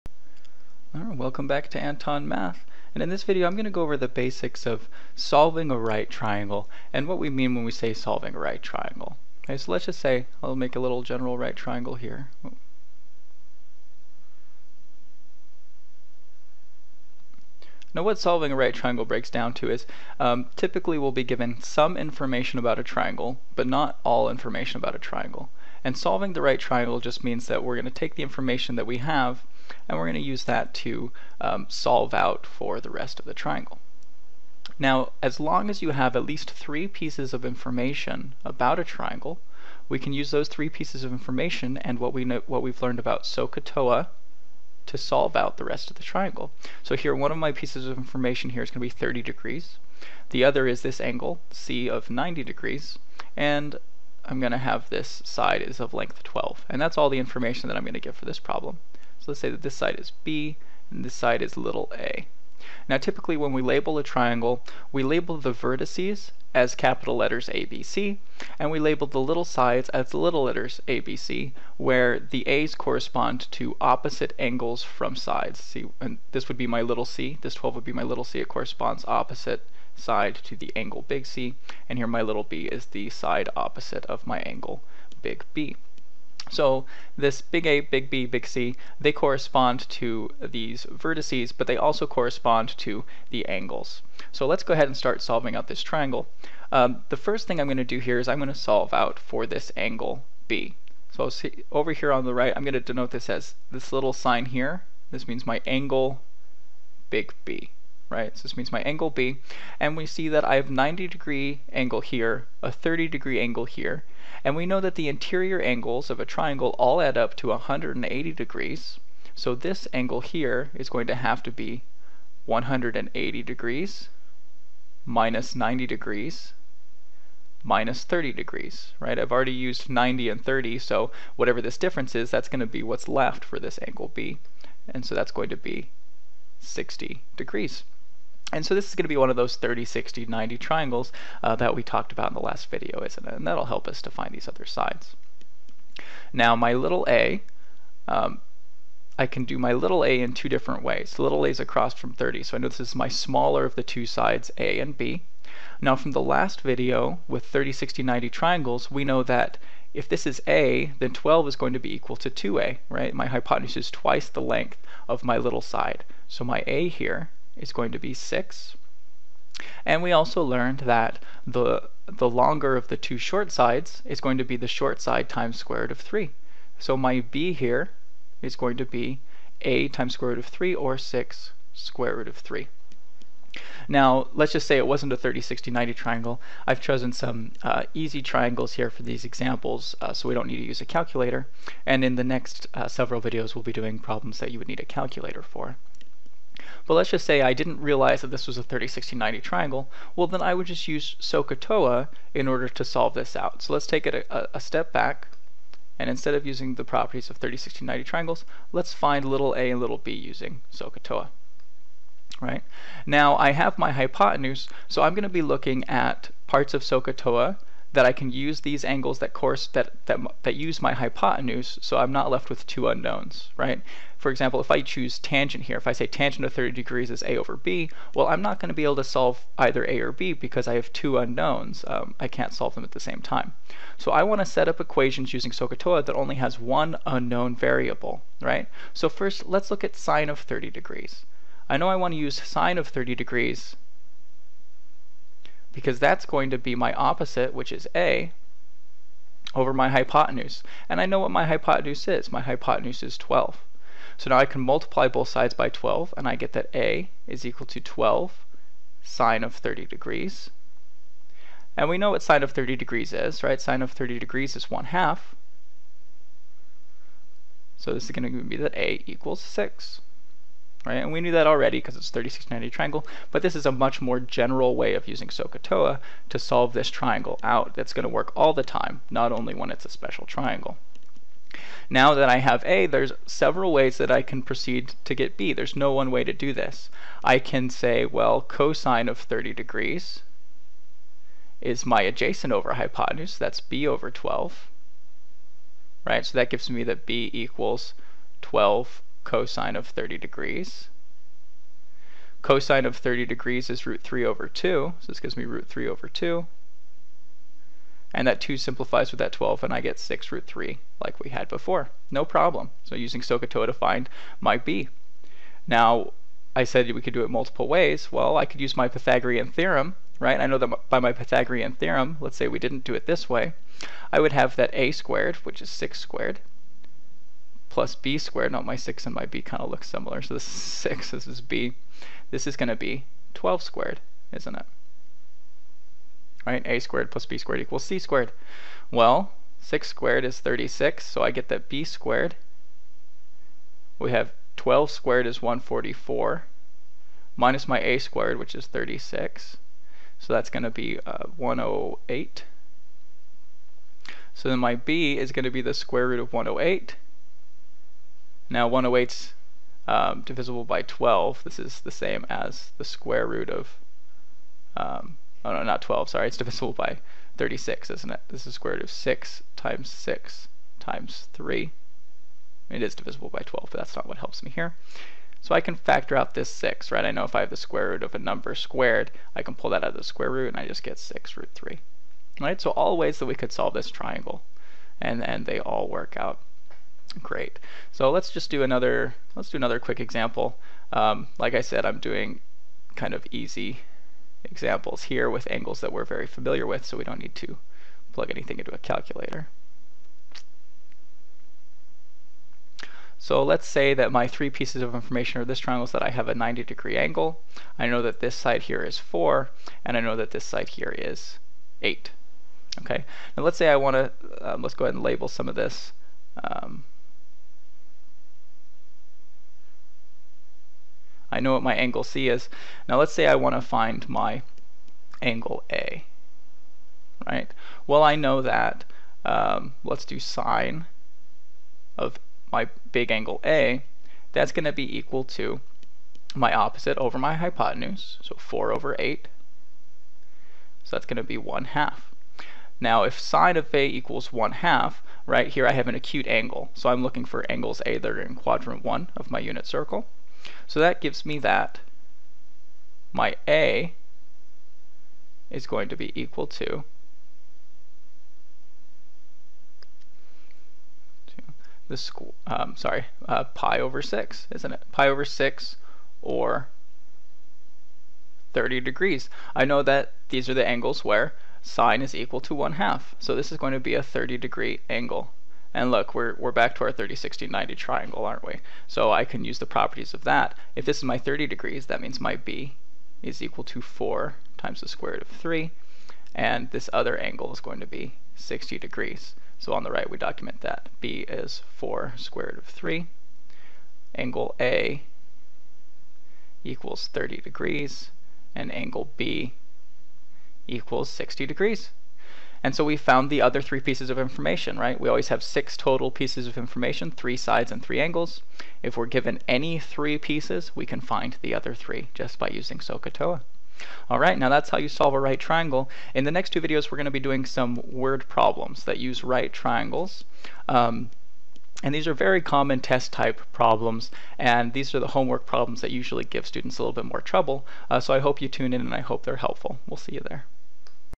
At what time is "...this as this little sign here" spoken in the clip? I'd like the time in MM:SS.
01:43.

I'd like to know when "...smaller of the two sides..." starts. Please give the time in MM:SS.
02:33.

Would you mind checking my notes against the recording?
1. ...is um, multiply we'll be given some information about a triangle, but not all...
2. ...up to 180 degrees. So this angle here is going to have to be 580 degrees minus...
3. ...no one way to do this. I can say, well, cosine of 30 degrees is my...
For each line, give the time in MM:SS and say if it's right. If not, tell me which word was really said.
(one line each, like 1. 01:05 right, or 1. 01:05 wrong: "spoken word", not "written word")
1. 00:19 wrong: "typically", not "multiply"
2. 01:57 wrong: "180", not "580"
3. 04:45 right.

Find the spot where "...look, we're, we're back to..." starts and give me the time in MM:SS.
07:55.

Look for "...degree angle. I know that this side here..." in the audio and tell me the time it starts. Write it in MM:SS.
06:46.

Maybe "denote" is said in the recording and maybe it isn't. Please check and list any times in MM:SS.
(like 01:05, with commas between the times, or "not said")
01:42.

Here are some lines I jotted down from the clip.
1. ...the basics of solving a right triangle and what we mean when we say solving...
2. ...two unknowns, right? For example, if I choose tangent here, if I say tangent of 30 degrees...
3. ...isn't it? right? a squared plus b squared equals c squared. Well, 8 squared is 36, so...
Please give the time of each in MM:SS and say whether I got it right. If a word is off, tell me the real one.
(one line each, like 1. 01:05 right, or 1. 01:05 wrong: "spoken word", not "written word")
1. 00:03 right
2. 03:42 right
3. 05:34 wrong: "6", not "8".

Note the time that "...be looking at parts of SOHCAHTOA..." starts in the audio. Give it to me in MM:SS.
03:35.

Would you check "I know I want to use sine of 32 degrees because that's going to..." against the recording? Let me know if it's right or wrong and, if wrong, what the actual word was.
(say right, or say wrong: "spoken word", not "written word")
wrong: "30", not "32".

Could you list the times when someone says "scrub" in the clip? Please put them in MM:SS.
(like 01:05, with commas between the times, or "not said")
not said.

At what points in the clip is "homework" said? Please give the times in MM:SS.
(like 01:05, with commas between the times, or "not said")
08:45.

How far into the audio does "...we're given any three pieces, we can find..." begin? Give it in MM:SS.
08:28.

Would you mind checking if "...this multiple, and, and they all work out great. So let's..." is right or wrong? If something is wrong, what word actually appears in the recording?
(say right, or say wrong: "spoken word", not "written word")
wrong: "triangle", not "multiple".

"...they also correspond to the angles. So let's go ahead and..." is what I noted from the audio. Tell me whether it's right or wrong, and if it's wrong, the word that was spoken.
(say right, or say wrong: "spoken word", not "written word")
right.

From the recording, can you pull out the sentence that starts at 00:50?
The other is this angle, C of 90 degrees, and I'm going to have this side is of length 12.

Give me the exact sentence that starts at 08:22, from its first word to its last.
And so we found the other three pieces of information, right?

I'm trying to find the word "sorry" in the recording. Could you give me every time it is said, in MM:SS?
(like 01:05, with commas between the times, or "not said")
06:06, 07:42.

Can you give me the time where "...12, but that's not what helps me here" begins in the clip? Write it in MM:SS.
06:13.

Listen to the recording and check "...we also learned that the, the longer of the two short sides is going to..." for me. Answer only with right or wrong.
right.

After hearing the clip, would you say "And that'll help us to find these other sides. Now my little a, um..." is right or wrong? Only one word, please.
right.